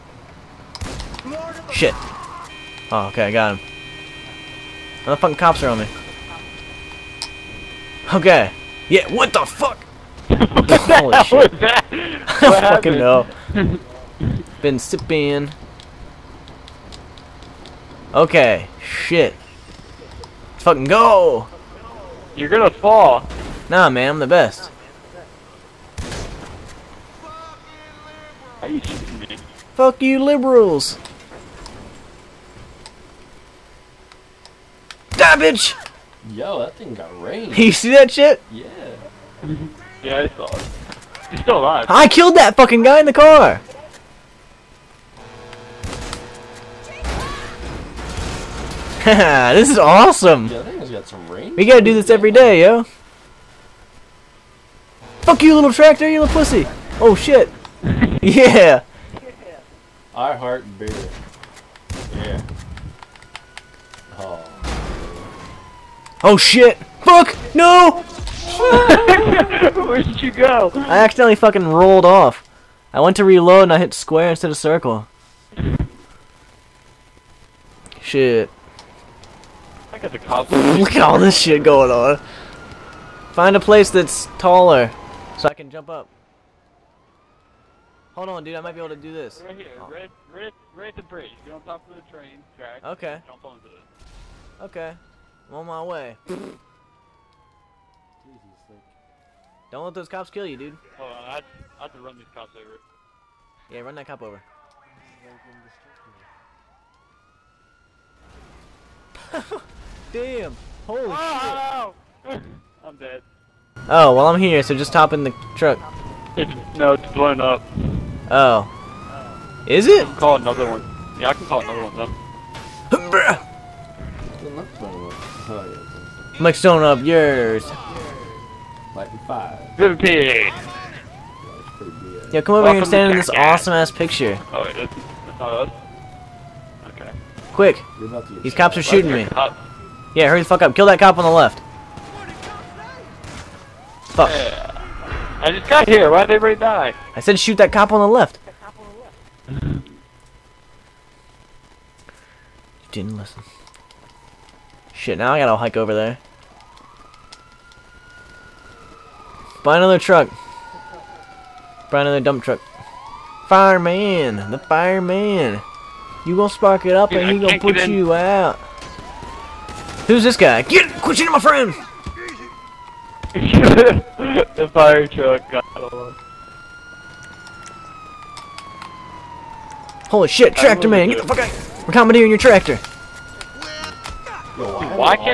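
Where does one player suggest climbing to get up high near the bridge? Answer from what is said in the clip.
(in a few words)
train track.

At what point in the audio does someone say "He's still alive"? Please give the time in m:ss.
0:41.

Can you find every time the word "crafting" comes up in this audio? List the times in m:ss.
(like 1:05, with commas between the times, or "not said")
not said.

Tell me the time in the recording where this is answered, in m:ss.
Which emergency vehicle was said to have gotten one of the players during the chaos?
2:54.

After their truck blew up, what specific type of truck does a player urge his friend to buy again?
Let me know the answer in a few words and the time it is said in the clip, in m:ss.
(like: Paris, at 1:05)
dump truck, at 2:42.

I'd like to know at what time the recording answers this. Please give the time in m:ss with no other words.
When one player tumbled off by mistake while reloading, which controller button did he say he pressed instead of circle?
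1:13.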